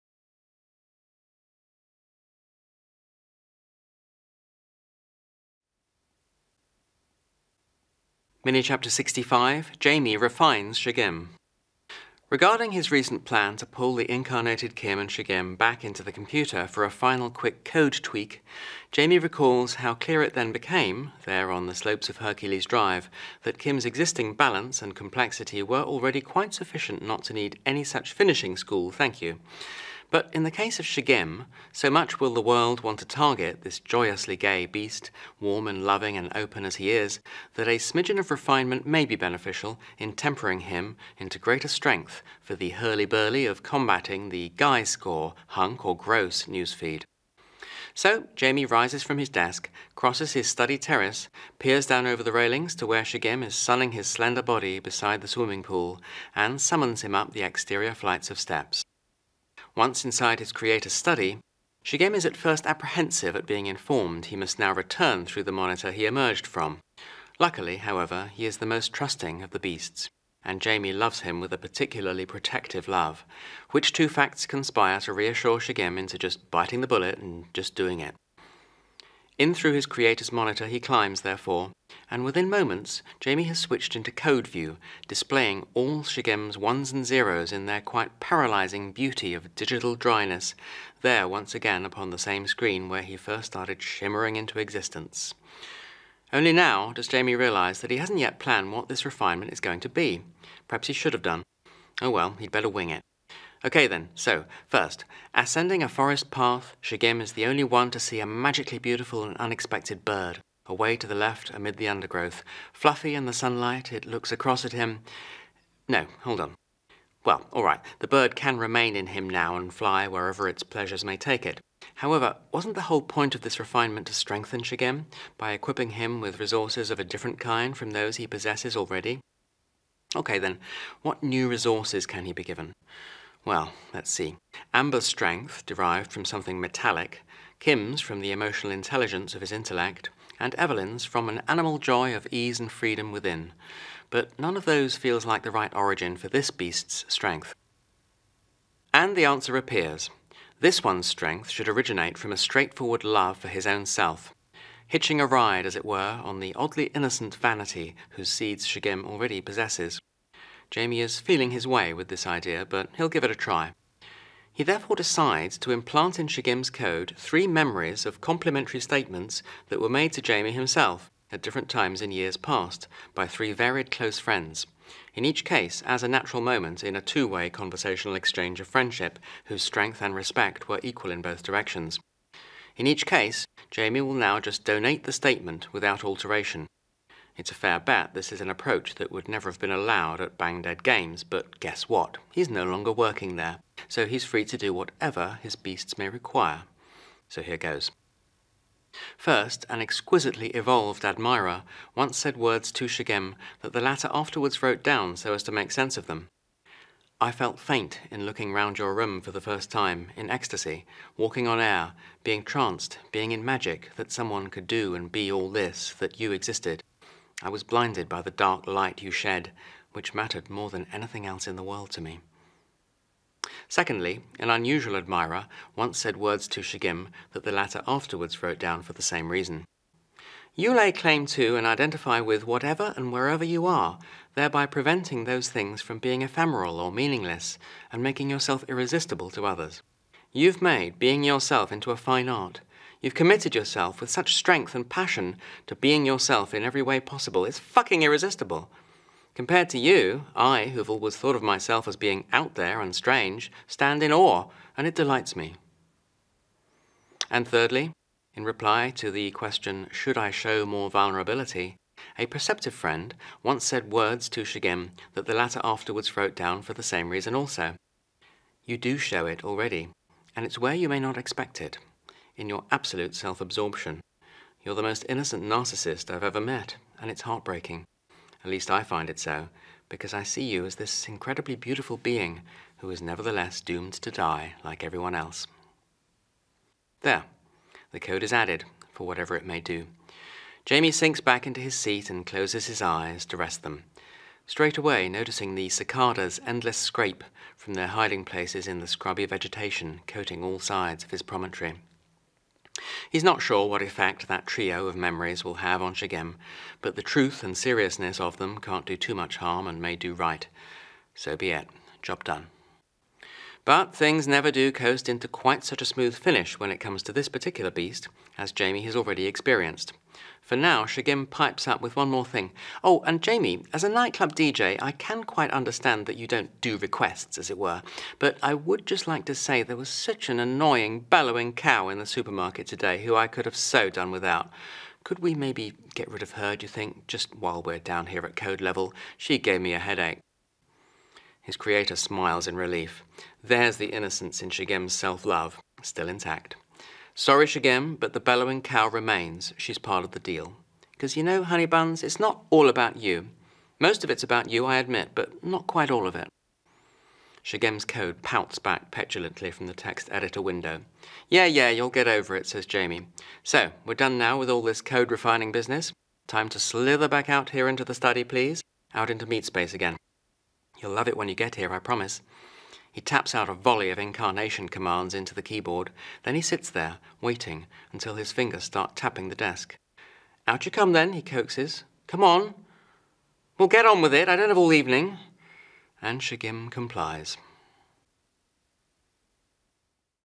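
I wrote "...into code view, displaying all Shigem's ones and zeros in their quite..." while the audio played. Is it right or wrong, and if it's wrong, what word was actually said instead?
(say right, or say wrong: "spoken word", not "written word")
right.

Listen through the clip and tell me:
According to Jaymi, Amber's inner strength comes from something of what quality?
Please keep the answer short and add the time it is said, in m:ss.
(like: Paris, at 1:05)
metallic, at 2:16.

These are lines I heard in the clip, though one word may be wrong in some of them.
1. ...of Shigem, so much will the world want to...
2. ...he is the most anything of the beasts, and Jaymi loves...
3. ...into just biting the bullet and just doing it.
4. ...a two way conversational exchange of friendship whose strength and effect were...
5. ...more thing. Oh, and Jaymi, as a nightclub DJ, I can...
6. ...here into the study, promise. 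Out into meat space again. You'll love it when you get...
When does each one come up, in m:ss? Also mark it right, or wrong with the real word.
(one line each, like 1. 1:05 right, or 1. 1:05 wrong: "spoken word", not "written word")
1. 0:30 right
2. 1:08 wrong: "trusting", not "anything"
3. 1:15 right
4. 2:56 wrong: "respect", not "effect"
5. 5:22 right
6. 6:07 wrong: "please", not "promise".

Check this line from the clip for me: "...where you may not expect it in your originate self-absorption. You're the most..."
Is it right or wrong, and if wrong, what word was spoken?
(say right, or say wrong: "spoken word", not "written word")
wrong: "absolute", not "originate".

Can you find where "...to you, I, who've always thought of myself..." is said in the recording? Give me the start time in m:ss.
4:09.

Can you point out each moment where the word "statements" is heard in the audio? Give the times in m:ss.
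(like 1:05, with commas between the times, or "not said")
2:48, 3:05.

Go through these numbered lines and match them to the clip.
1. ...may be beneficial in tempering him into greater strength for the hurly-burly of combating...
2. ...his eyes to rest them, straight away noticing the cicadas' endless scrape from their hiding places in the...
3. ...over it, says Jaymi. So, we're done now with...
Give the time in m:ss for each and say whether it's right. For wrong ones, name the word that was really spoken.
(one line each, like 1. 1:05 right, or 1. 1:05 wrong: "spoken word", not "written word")
1. 0:38 right
2. 4:52 right
3. 6:02 right.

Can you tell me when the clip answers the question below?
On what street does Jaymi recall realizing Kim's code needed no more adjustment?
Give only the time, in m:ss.
0:22.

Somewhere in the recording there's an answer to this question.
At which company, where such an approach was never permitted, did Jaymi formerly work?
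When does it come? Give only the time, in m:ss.
3:10.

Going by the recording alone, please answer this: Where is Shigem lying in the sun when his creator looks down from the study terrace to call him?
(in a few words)
beside the swimming pool.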